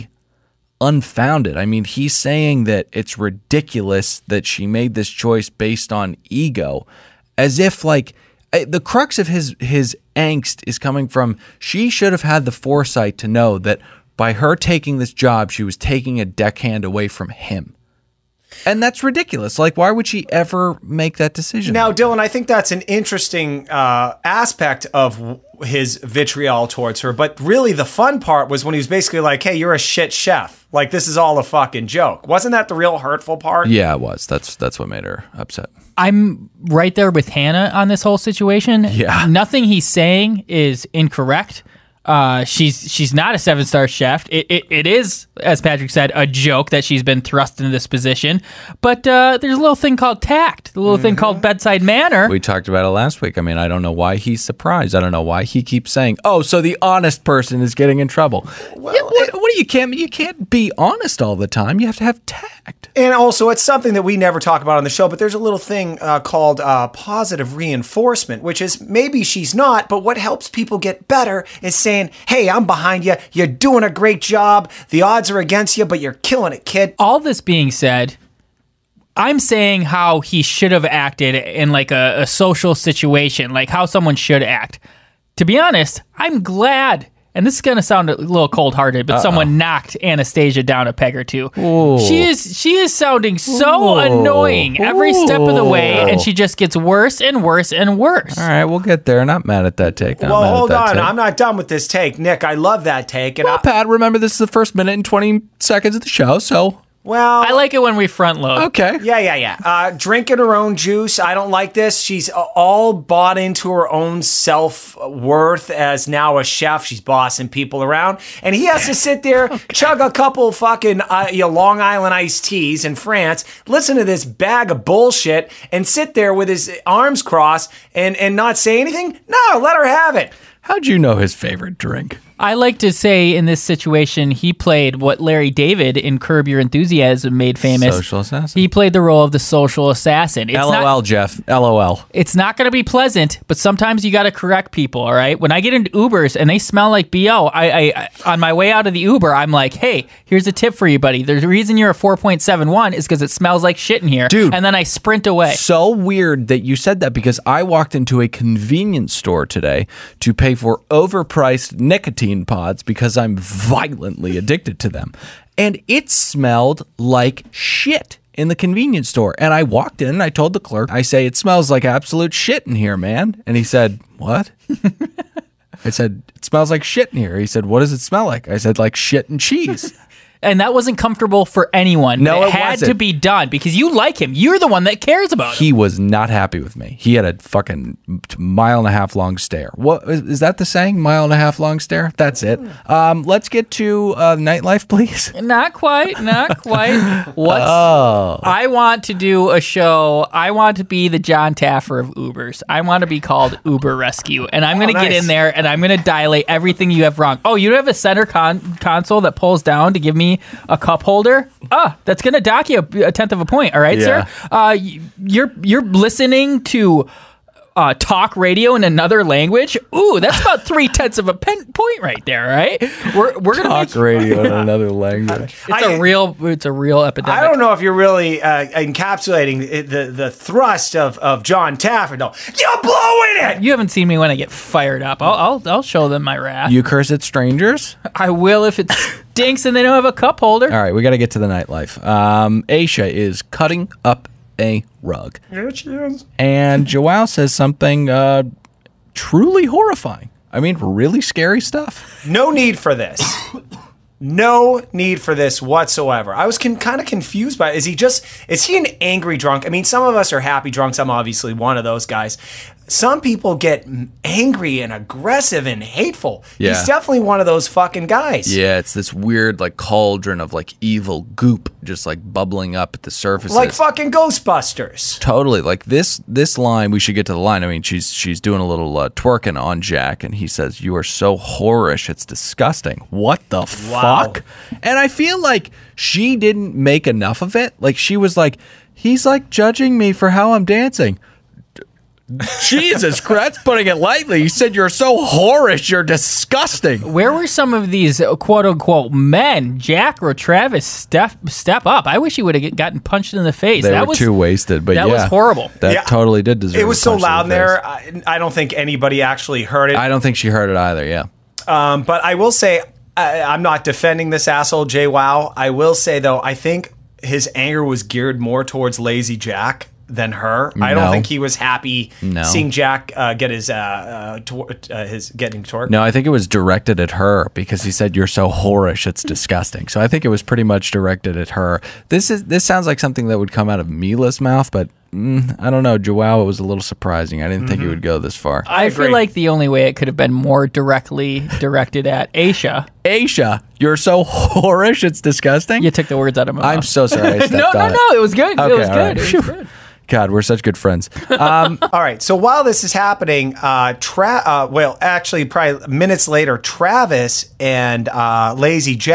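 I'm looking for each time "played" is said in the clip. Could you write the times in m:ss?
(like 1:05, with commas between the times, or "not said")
2:14, 2:18.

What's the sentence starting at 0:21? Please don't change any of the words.
Now, Dylan, I think that's an interesting uh, aspect of his vitriol towards her.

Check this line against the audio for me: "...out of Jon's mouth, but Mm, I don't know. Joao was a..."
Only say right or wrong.
wrong.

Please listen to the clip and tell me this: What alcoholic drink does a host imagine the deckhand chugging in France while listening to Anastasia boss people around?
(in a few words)
Long Island iced teas.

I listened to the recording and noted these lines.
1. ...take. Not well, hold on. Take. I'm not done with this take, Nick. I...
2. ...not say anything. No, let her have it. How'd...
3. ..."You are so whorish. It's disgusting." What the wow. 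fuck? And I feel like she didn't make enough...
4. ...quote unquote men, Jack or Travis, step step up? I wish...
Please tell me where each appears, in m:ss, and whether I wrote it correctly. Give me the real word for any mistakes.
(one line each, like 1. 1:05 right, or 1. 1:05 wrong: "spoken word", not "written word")
1. 1:39 right
2. 2:08 right
3. 4:40 right
4. 4:58 right.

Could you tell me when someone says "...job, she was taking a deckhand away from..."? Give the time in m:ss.
0:15.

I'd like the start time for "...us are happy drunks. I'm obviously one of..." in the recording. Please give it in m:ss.
4:20.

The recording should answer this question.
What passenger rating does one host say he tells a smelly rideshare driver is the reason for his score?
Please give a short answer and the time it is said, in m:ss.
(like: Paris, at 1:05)
4.71, at 2:31.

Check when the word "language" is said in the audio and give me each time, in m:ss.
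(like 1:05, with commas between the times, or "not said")
3:39, 3:44.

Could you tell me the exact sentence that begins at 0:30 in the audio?
Like this is all a fucking joke." Wasn't that the real hurtful part?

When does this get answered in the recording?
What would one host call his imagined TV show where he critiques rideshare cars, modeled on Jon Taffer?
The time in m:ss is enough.
3:23.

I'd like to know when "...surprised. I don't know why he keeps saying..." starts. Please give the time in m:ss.
0:54.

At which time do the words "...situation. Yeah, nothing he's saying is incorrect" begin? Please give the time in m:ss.
0:38.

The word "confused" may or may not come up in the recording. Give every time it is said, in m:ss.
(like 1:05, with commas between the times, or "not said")
4:17.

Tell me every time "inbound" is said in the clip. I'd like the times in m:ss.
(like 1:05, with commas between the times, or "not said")
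not said.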